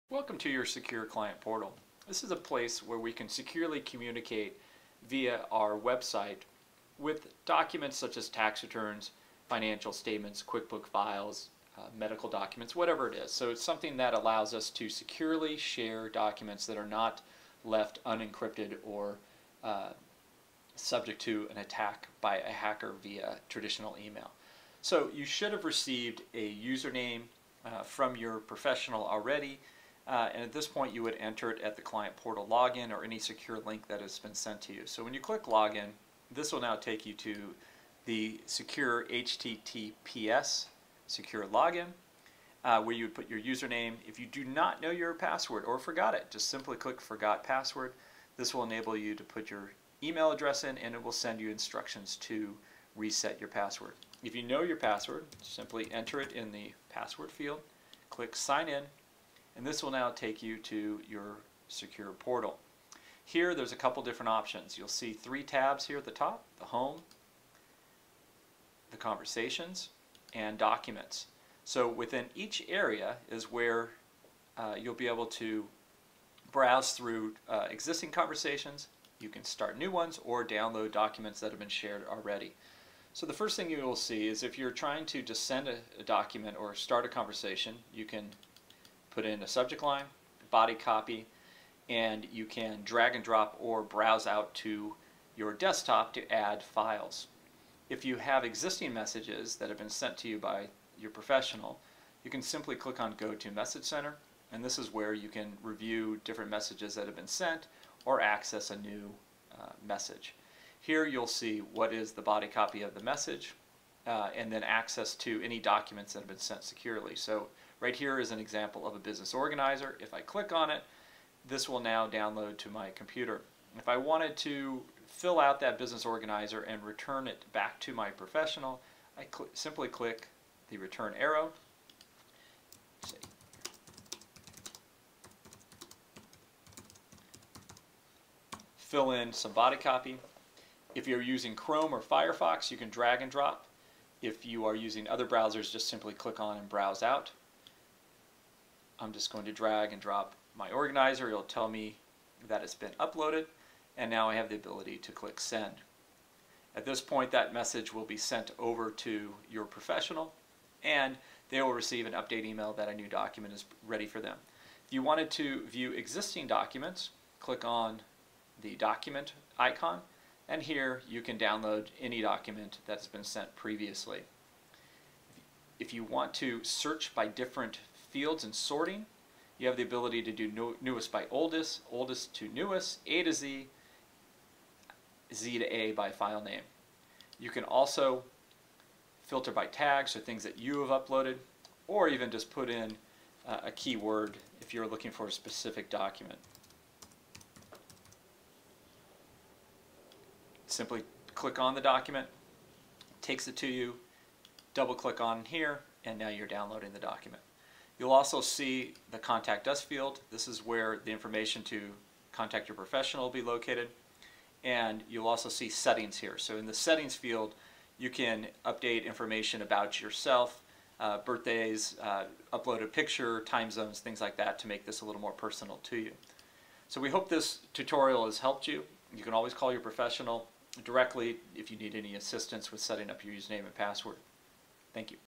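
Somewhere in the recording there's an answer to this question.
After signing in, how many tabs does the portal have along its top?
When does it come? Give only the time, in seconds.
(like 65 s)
65 s.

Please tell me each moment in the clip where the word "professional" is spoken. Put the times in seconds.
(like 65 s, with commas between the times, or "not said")
28 s, 101 s, 128 s, 159 s, 212 s, 229 s.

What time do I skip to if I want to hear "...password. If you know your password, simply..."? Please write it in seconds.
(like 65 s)
53 s.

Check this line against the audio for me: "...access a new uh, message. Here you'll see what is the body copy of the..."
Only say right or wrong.
right.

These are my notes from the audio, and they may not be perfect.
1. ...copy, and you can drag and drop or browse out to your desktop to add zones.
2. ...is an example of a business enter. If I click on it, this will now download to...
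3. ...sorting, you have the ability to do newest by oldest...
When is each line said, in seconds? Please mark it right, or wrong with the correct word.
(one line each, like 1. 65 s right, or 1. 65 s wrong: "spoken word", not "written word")
1. 90 s wrong: "files", not "zones"
2. 118 s wrong: "organizer", not "enter"
3. 178 s right.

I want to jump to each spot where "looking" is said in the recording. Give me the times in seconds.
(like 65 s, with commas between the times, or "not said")
194 s.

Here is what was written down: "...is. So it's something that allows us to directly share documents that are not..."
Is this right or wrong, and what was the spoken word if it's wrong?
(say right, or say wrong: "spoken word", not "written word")
wrong: "securely", not "directly".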